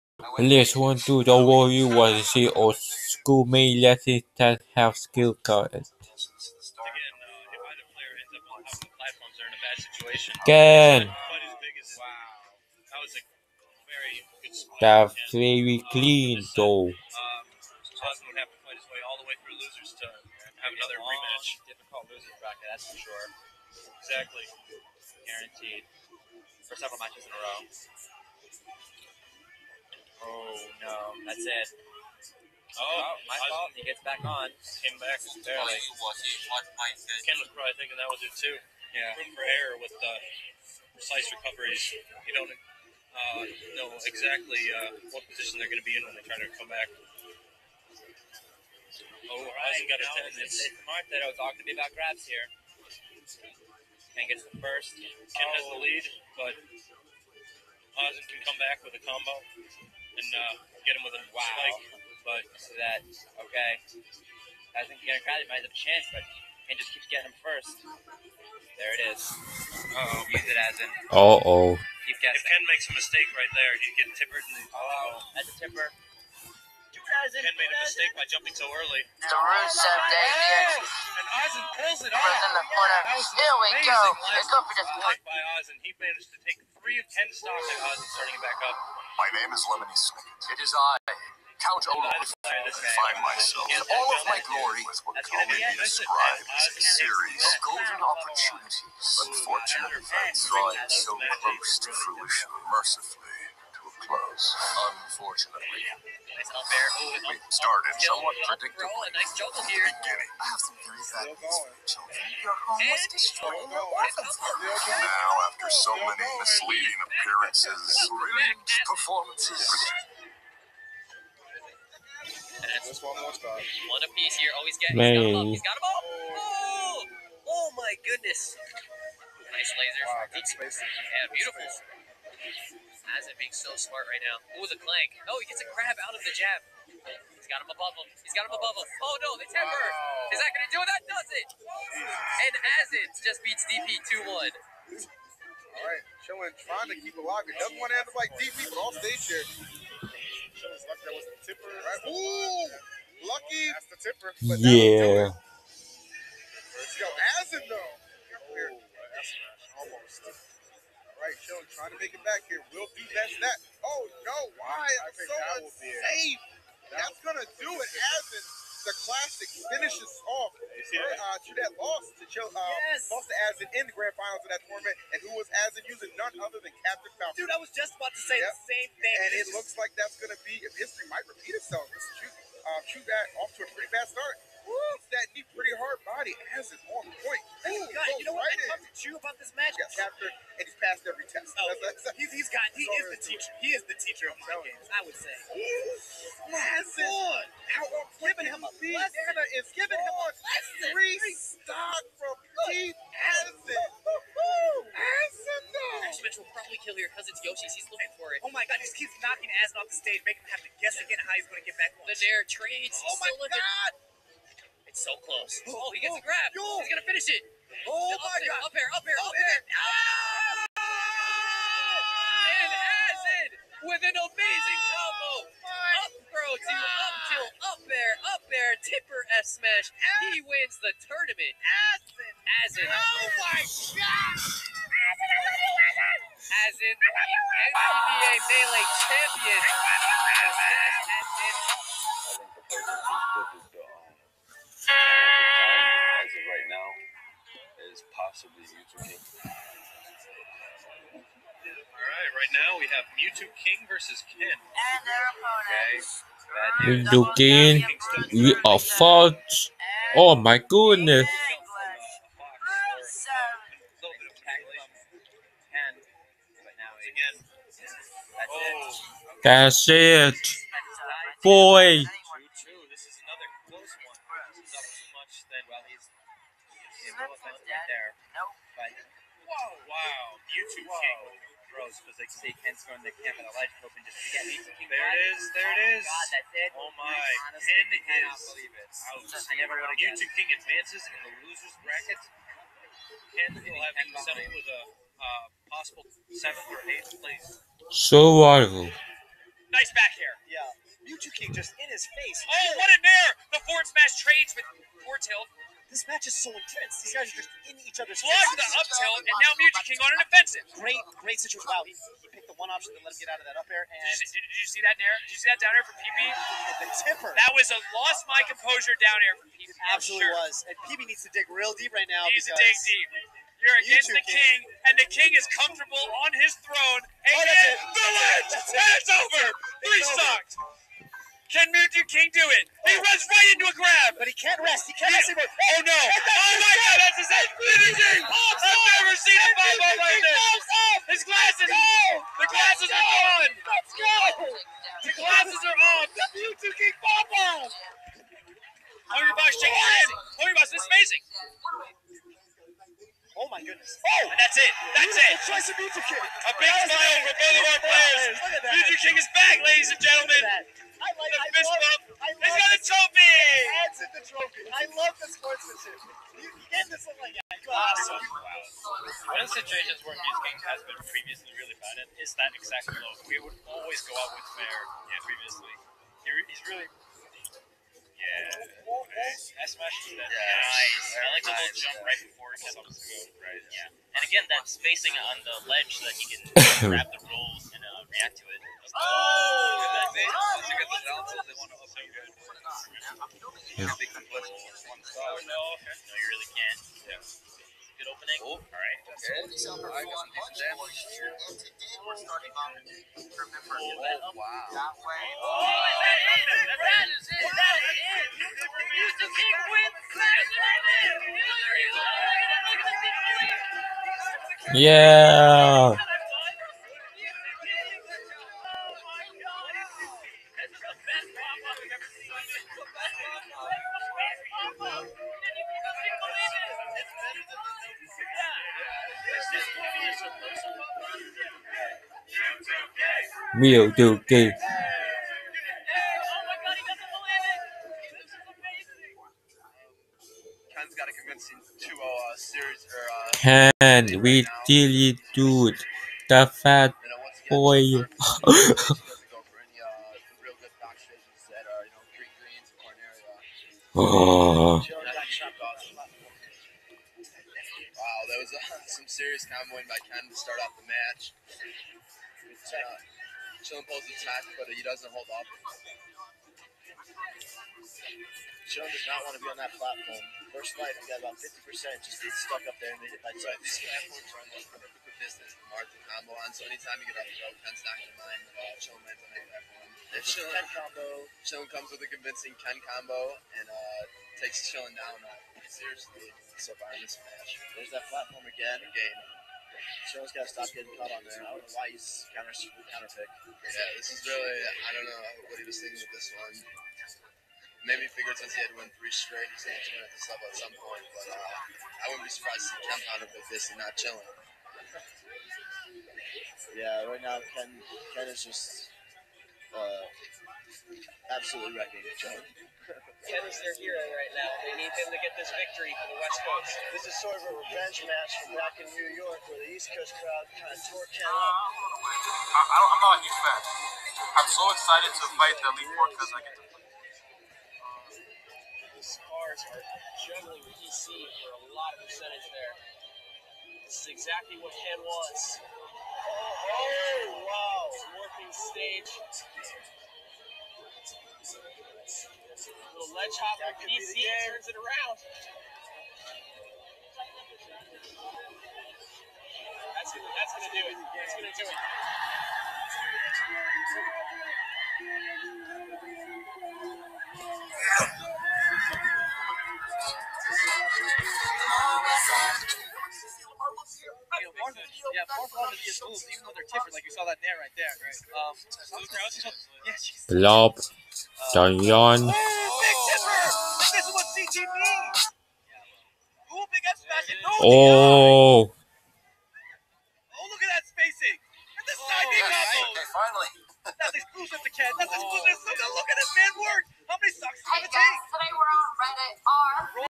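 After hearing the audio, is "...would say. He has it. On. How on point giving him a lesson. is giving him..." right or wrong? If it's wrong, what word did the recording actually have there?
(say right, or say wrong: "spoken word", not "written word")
right.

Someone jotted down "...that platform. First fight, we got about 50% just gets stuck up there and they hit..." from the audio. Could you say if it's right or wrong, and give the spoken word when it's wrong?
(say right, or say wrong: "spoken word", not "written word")
right.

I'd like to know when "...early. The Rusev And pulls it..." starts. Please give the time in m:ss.
1:18.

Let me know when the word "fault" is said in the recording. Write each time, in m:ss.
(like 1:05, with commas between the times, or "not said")
0:33, 4:18.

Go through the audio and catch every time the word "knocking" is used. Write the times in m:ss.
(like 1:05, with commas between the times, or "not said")
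3:29.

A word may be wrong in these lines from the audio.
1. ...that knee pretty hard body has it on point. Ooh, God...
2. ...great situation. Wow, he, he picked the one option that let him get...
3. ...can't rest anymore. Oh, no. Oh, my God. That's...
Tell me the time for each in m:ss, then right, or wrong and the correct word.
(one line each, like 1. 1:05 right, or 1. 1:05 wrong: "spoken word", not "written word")
1. 3:05 right
2. 5:11 right
3. 5:34 right.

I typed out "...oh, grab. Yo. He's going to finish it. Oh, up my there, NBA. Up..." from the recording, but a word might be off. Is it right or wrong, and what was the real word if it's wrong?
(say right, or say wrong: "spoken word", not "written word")
wrong: "God", not "NBA".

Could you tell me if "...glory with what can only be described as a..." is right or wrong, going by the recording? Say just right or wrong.
right.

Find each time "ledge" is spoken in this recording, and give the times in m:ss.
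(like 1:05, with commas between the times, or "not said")
4:43, 5:28, 6:25, 9:03.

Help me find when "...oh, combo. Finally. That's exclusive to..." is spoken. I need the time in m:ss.
9:42.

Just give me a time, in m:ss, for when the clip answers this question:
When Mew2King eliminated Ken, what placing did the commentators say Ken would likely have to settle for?
4:56.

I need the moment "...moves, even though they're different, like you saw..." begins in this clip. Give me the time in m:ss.
9:26.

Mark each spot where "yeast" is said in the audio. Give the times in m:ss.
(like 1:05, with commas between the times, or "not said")
not said.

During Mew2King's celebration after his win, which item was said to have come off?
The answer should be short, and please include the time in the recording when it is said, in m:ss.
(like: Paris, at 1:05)
His glasses, at 5:41.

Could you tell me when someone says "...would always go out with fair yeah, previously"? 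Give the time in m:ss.
6:13.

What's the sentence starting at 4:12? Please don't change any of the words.
now we have Mew2King versus Ken.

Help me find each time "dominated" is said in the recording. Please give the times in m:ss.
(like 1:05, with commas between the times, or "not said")
not said.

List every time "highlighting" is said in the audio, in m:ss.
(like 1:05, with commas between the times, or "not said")
not said.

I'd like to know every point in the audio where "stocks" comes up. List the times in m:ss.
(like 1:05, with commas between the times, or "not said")
1:27, 3:21.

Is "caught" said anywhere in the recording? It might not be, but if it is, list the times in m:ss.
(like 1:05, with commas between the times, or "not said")
8:10.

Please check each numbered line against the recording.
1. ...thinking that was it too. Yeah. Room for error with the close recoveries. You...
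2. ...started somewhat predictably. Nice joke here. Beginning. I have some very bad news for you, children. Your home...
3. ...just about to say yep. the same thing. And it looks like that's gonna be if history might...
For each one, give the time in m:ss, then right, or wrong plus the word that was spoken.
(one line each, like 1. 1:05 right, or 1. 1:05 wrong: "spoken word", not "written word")
1. 0:37 wrong: "precise", not "close"
2. 1:47 right
3. 2:57 right.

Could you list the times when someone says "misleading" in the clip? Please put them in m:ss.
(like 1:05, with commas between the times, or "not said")
1:56.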